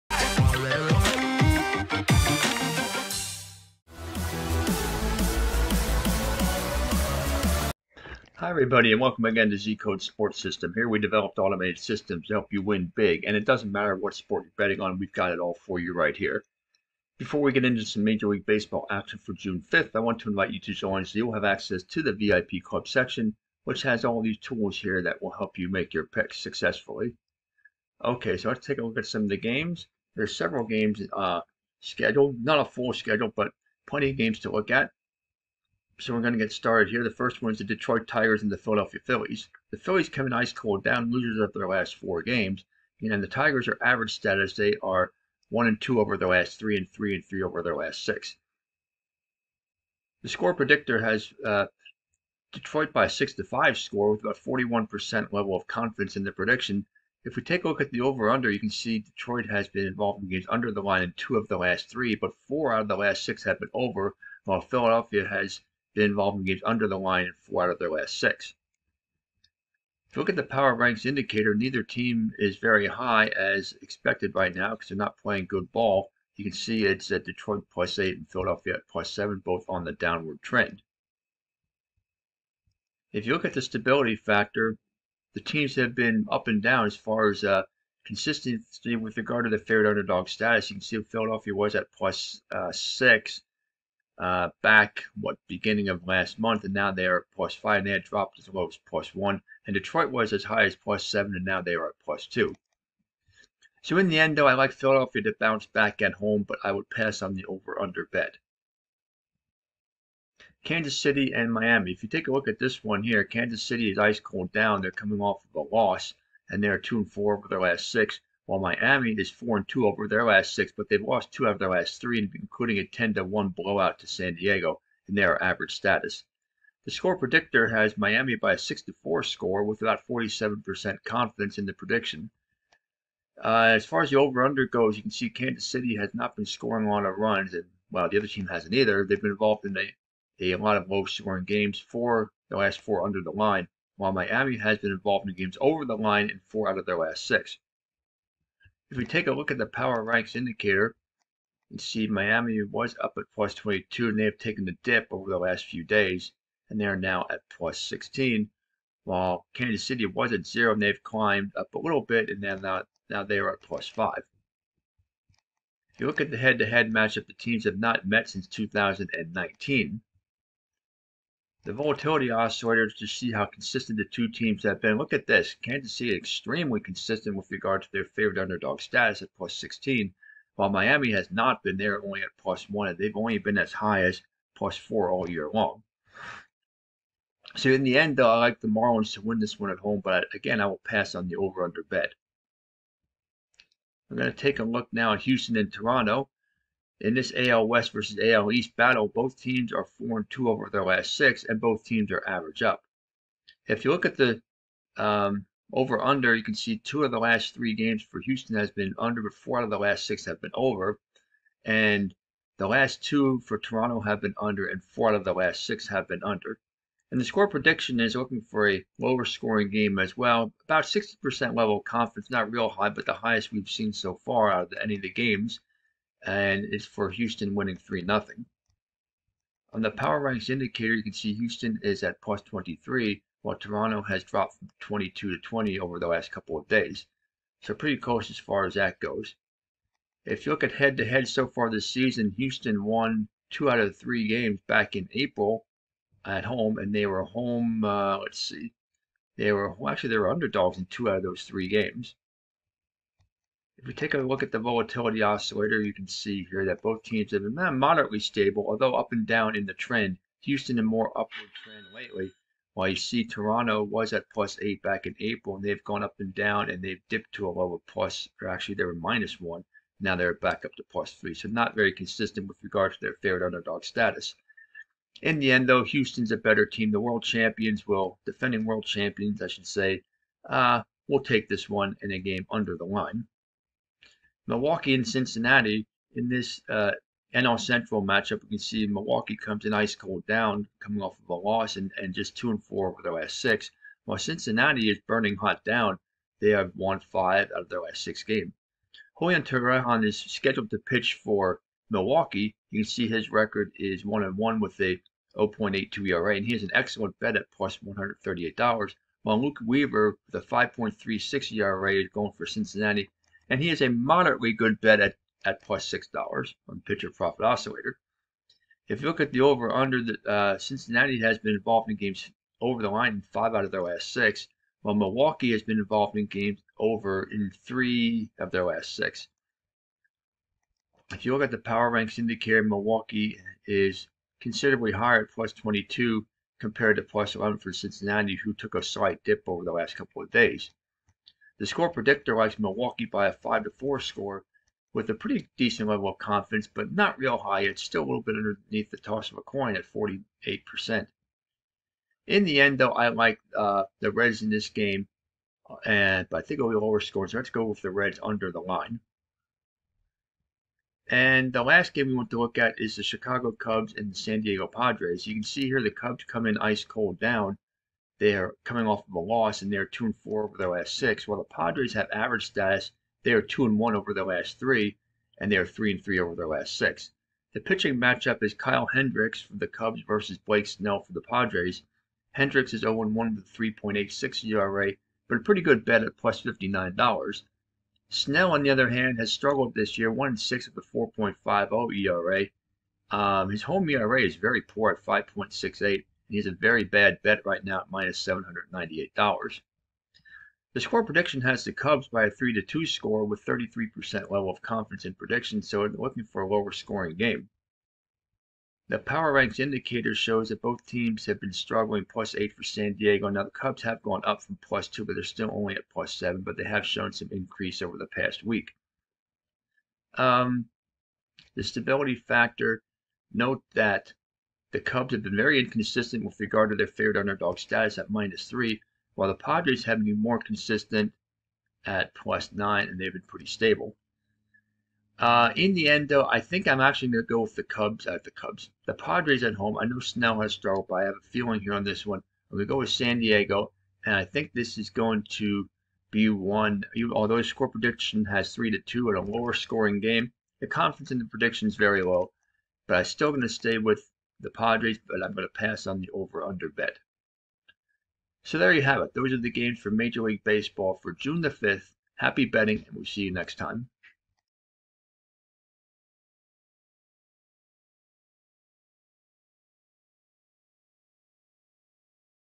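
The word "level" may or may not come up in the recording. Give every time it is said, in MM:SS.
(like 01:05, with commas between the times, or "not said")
00:55, 03:41, 05:45, 06:44.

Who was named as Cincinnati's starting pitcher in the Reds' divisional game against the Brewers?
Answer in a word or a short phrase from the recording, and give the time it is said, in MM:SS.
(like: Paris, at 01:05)
Luke Weaver, at 05:09.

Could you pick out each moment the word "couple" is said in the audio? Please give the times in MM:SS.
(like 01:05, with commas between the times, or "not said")
03:56, 05:39.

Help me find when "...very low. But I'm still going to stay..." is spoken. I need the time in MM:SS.
07:31.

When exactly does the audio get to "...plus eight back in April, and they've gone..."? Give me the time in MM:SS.
04:24.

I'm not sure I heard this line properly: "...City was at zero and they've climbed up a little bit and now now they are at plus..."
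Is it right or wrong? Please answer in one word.
right.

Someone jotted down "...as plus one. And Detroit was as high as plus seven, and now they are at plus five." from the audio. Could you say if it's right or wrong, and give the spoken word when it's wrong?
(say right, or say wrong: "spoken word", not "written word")
wrong: "two", not "five".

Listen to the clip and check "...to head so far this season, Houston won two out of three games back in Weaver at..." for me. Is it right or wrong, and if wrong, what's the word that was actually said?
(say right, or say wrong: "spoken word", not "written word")
wrong: "April", not "Weaver".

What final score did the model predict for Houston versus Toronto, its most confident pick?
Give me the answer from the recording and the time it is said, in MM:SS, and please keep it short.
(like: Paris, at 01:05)
3-0, at 03:47.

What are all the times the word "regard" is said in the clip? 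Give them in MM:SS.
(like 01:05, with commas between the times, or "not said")
01:29, 02:57, 04:32, 07:06.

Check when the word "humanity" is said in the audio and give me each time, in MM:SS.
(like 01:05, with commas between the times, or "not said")
not said.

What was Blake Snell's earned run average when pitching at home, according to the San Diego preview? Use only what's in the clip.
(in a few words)
5.68.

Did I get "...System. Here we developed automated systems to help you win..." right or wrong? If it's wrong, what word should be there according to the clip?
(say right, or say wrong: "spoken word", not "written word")
right.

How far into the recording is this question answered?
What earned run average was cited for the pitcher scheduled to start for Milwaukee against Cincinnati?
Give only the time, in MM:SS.
05:05.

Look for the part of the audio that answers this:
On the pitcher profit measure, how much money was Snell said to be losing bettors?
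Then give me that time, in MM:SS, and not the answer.
06:37.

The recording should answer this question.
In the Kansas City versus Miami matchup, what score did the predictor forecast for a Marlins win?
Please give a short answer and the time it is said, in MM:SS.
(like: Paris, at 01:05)
6 to 4, at 02:08.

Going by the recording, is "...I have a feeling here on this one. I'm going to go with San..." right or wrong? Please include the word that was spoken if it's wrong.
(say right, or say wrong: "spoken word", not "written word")
right.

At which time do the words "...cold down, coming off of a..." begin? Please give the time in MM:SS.
04:49.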